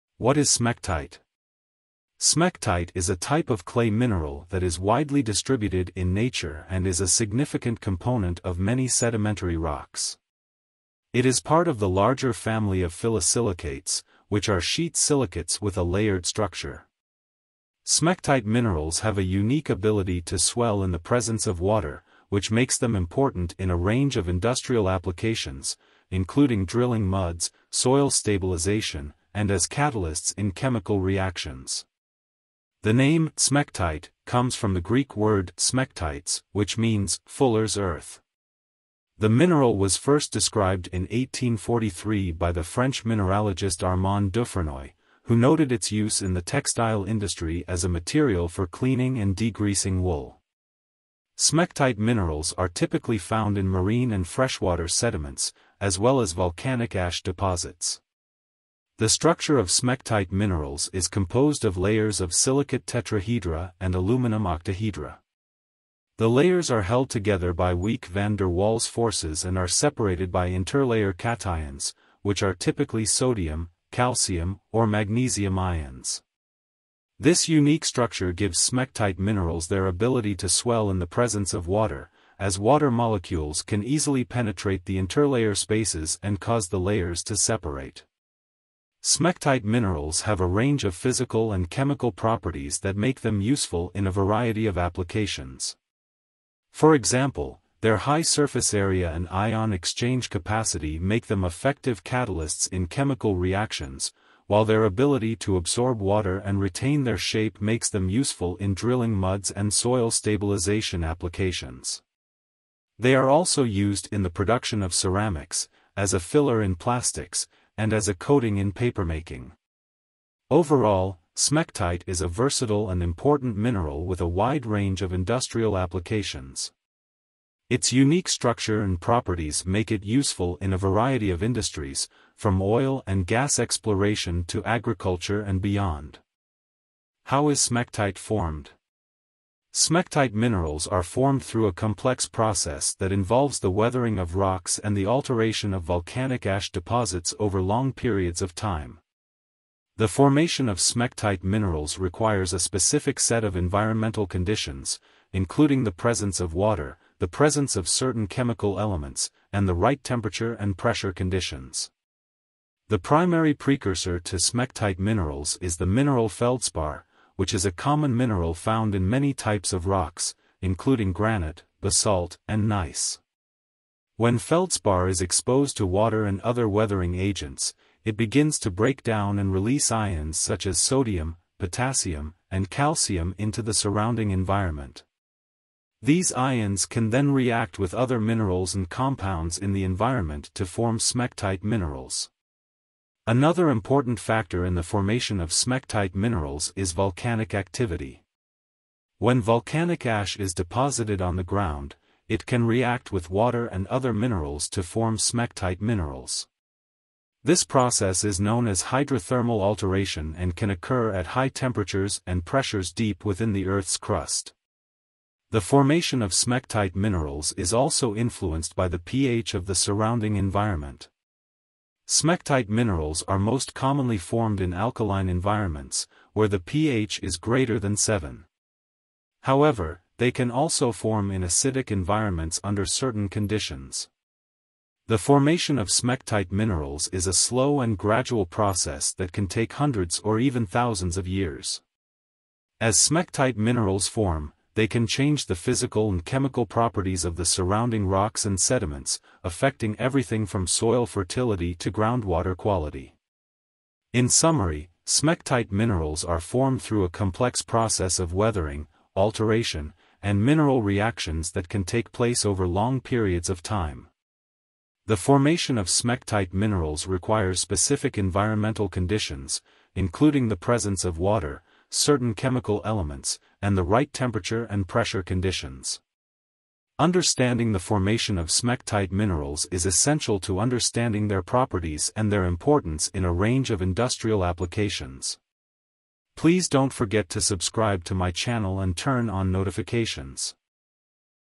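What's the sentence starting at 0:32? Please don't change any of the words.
The name smectite comes from the Greek word smectites, which means fuller's earth.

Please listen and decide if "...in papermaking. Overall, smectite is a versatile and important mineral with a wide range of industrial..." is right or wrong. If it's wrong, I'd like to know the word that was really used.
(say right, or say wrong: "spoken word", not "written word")
right.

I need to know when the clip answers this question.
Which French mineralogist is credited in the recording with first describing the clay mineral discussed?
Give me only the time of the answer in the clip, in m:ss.
0:43.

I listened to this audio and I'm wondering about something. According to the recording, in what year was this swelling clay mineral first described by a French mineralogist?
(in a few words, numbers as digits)
1843.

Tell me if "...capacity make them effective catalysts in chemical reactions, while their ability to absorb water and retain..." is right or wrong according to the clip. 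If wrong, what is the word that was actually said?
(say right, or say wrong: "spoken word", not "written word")
right.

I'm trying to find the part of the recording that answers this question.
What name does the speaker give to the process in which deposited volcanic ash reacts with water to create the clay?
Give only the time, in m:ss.
3:28.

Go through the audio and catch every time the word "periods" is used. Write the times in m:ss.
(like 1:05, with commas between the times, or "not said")
2:27, 4:23.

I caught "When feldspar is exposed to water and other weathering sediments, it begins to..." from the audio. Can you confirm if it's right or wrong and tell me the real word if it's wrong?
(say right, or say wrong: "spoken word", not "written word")
wrong: "agents", not "sediments".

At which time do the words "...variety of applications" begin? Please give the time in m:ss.
1:34.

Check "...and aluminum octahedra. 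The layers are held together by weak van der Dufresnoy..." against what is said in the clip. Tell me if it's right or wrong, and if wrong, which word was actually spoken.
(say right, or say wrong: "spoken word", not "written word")
wrong: "Waals", not "Dufresnoy".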